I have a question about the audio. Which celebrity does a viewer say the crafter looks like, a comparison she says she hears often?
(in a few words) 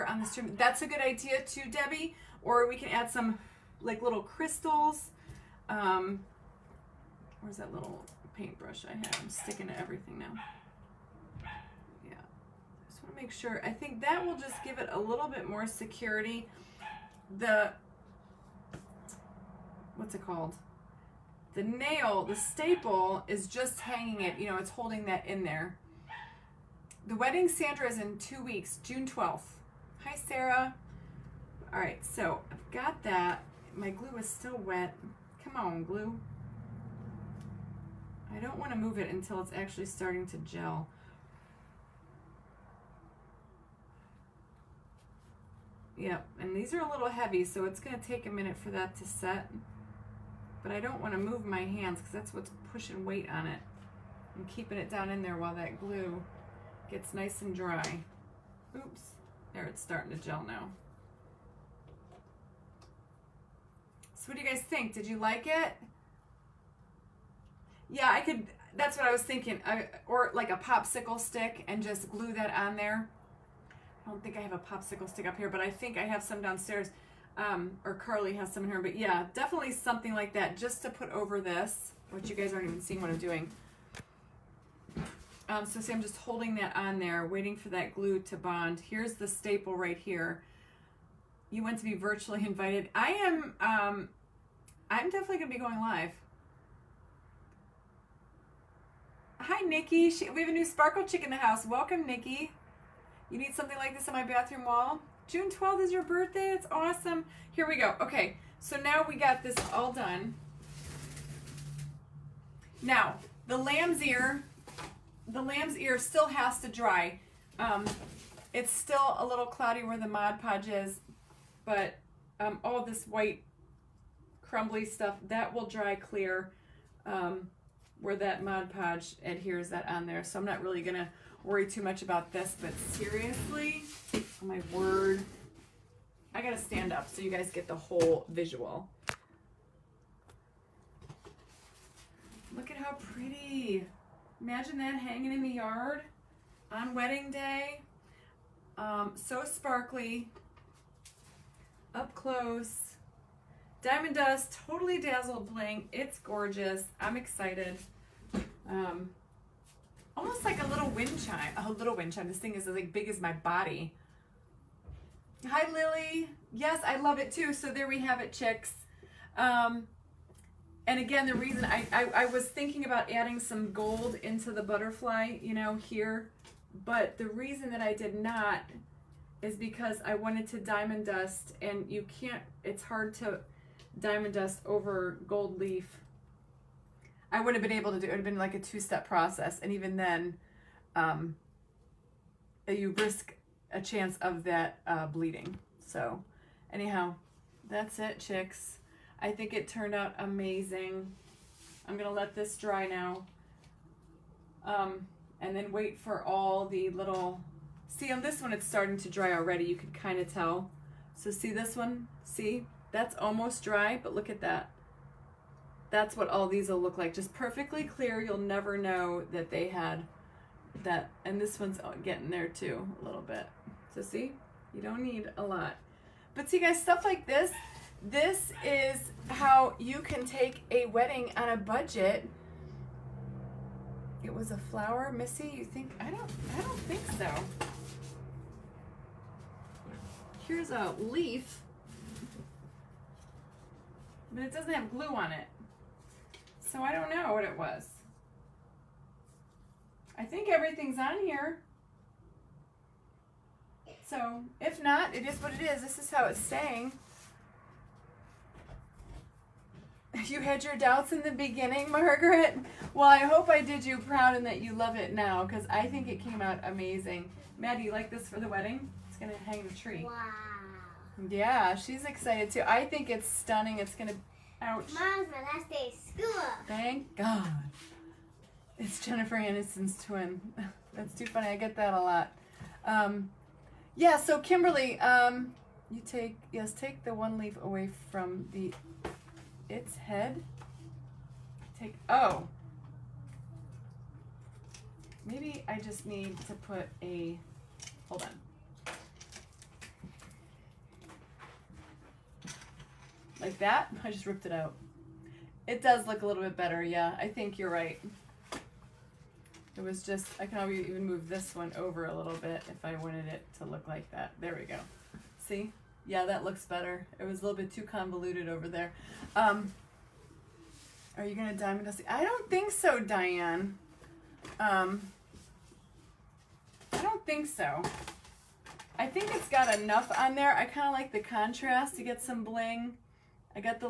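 Jennifer Aniston.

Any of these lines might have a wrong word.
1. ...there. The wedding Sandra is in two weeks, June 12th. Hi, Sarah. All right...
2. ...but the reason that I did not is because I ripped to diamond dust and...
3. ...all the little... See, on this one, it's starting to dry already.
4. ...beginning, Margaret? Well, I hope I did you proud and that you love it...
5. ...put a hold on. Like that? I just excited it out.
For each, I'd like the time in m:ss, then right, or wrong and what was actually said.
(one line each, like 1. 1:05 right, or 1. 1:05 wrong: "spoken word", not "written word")
1. 0:25 right
2. 2:56 wrong: "wanted", not "ripped"
3. 3:26 right
4. 4:21 right
5. 4:56 wrong: "ripped", not "excited".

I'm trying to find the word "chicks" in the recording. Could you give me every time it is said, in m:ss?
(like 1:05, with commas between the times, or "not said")
1:41, 2:48, 3:18.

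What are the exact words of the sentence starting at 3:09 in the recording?
And even then, um, you risk a chance of that uh, bleeding.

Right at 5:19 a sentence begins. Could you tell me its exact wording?
Um, are you going to diamond dust?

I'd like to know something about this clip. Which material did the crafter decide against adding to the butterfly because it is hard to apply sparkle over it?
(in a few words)
Gold leaf.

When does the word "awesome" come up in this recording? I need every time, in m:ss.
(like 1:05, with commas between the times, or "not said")
1:46.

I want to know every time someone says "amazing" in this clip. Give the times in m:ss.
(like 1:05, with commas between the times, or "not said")
3:20, 4:26.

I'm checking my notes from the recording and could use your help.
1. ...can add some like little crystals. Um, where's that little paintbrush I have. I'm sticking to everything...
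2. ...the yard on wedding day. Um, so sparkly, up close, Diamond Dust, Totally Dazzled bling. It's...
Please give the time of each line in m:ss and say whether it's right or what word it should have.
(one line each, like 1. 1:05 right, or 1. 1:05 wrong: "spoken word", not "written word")
1. 0:02 right
2. 2:25 right.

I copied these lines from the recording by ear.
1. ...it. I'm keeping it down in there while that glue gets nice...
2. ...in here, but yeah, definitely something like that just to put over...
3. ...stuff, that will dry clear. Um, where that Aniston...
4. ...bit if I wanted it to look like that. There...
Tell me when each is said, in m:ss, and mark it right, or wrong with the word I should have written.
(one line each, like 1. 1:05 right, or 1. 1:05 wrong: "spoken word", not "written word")
1. 0:53 right
2. 1:18 right
3. 2:04 wrong: "Mod", not "Aniston"
4. 5:12 right.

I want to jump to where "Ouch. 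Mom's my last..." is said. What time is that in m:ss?
4:34.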